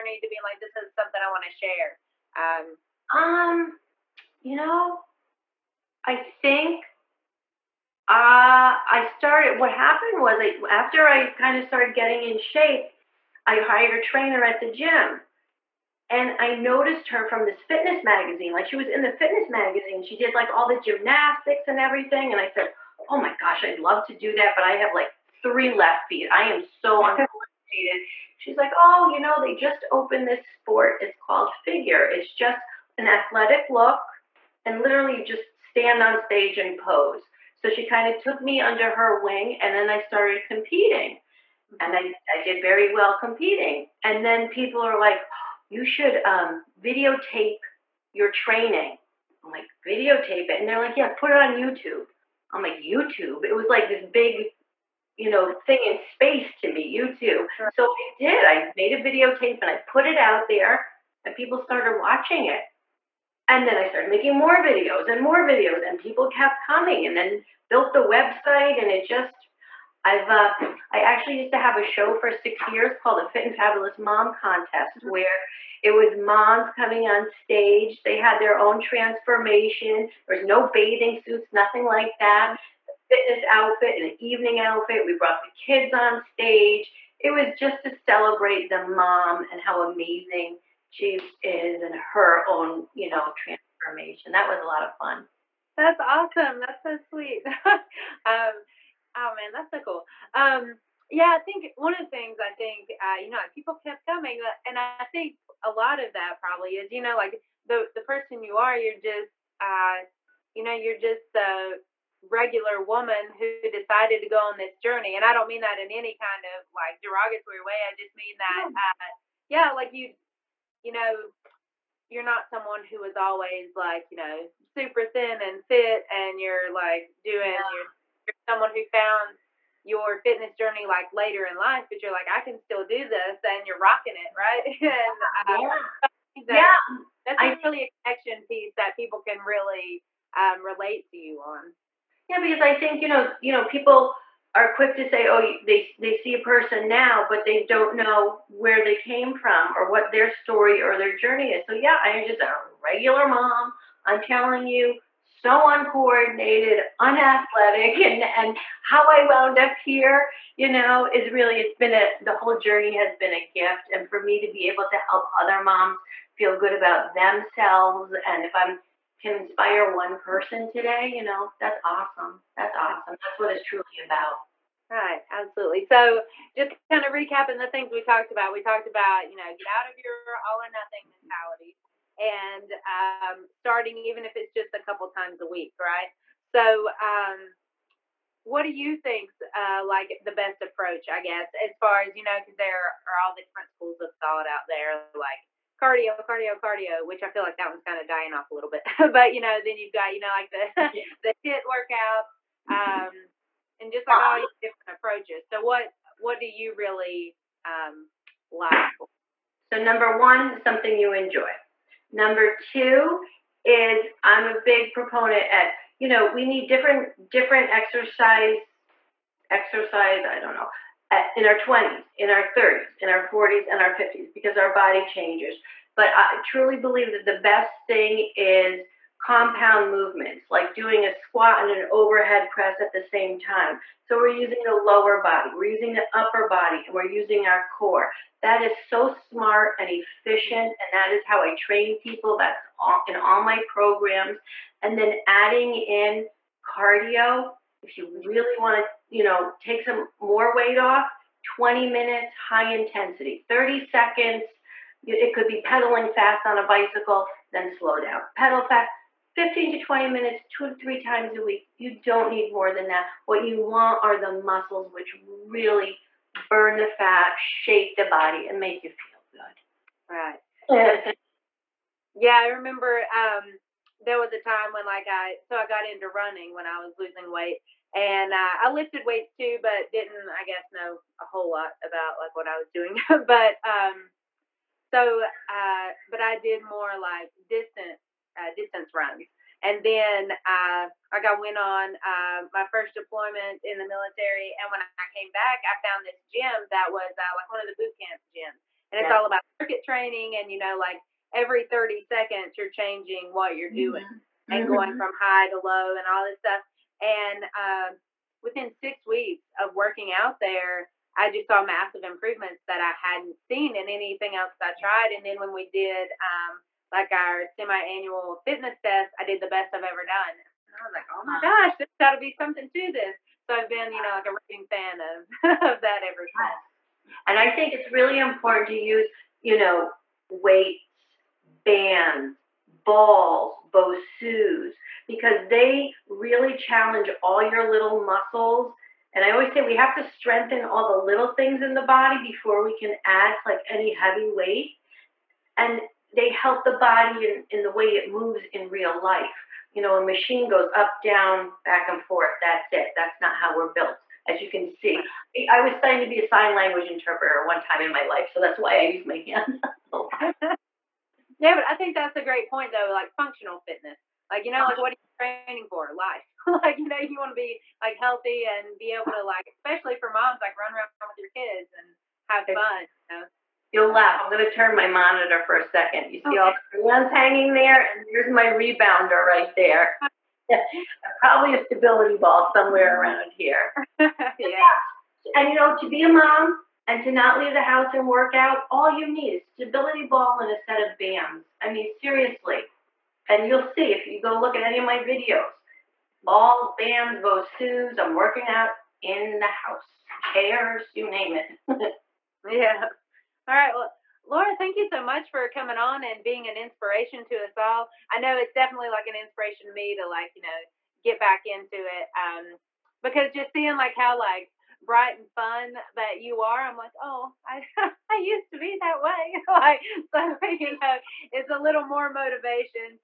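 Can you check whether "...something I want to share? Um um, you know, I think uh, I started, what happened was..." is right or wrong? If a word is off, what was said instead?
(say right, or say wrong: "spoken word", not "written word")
right.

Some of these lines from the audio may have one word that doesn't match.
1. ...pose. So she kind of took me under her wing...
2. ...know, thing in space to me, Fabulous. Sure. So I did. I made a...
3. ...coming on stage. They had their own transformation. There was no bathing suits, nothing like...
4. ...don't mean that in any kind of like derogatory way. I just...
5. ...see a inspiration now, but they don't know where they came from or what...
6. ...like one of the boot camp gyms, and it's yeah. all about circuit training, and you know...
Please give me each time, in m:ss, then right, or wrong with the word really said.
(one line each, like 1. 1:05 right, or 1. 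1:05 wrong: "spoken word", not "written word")
1. 0:36 right
2. 0:55 wrong: "YouTube", not "Fabulous"
3. 1:16 right
4. 1:55 right
5. 2:26 wrong: "person", not "inspiration"
6. 4:57 right.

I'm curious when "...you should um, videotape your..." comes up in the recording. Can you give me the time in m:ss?
0:45.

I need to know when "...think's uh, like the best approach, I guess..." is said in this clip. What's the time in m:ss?
3:08.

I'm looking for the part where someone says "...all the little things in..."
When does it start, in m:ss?
5:40.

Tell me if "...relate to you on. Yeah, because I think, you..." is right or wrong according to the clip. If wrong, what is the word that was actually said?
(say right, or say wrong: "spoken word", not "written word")
right.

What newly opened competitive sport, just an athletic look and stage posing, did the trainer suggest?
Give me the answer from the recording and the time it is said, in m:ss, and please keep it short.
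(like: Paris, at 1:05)
Figure, at 0:31.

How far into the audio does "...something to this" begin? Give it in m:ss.
5:22.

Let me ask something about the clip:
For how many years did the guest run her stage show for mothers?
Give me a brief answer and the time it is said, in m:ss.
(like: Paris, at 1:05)
6, at 1:12.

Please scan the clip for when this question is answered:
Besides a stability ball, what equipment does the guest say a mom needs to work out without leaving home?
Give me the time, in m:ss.
6:30.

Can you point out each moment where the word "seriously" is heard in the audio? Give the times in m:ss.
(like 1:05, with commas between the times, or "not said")
6:31.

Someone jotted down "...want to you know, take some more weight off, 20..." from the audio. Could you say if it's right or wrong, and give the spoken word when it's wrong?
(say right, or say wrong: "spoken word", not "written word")
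right.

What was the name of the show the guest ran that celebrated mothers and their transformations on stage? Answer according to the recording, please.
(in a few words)
Fit and Fabulous Mom Contest.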